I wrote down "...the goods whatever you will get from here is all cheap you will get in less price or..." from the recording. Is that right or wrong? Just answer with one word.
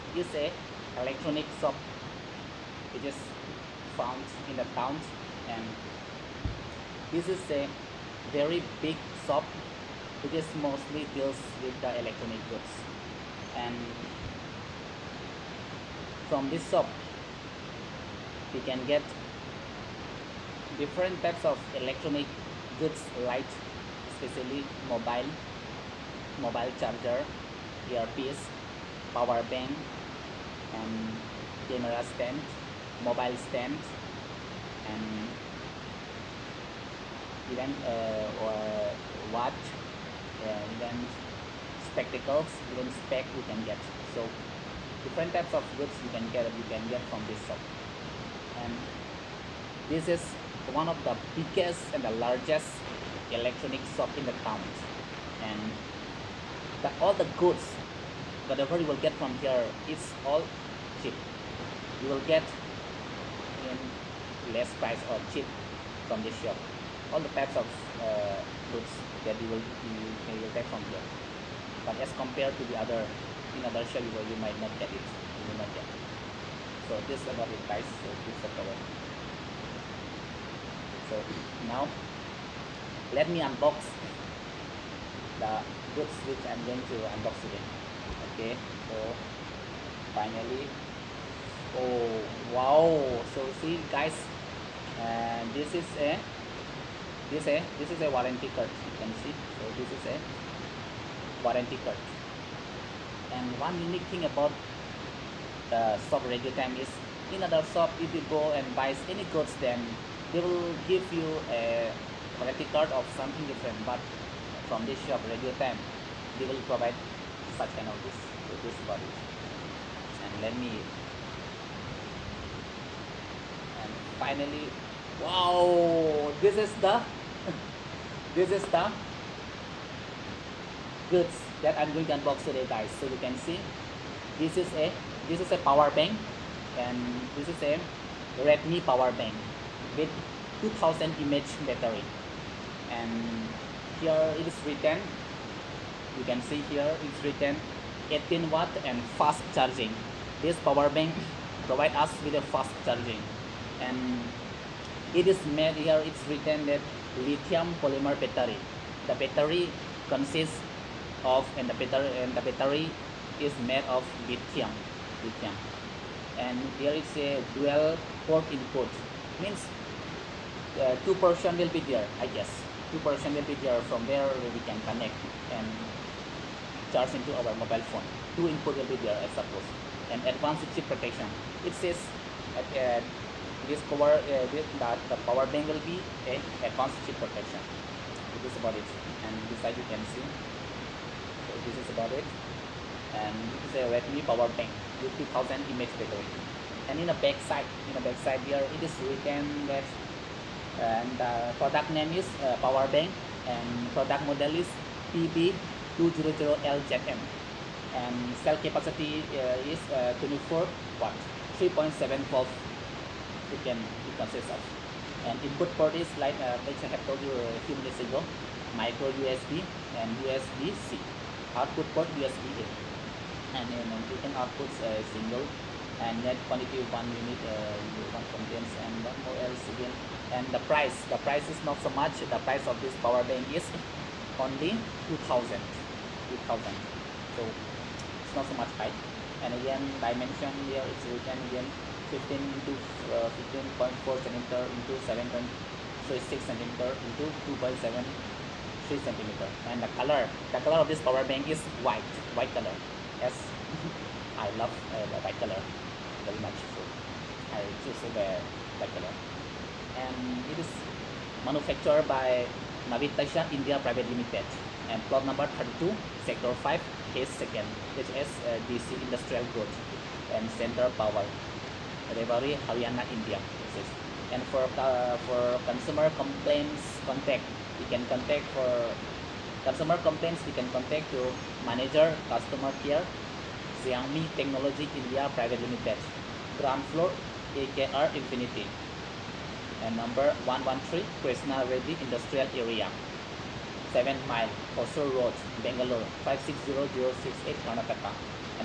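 right.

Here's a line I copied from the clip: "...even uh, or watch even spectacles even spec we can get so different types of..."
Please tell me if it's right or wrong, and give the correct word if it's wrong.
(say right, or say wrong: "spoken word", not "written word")
right.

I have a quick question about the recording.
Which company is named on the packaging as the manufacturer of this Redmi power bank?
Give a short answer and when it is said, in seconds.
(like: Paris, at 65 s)
Navitasys India Private Limited, at 262 s.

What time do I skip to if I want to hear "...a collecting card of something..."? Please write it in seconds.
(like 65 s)
111 s.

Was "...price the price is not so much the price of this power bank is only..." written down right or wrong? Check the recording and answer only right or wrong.
right.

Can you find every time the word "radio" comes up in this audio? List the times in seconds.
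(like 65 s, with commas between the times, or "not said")
106 s, 115 s.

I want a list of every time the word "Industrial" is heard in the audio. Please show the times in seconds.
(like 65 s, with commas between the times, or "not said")
269 s, 292 s.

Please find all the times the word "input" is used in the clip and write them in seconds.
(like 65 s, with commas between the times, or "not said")
168 s, 178 s, 215 s.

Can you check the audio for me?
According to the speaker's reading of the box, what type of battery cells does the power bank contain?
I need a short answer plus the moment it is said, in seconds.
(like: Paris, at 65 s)
Lithium polymer, at 157 s.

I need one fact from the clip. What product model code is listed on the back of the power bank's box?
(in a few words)
PB200LZM.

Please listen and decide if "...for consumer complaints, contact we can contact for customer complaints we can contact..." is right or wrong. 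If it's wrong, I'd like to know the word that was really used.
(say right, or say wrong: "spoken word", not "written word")
right.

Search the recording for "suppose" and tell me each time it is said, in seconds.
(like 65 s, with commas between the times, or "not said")
179 s.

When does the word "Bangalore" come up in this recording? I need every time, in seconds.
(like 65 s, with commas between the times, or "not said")
295 s.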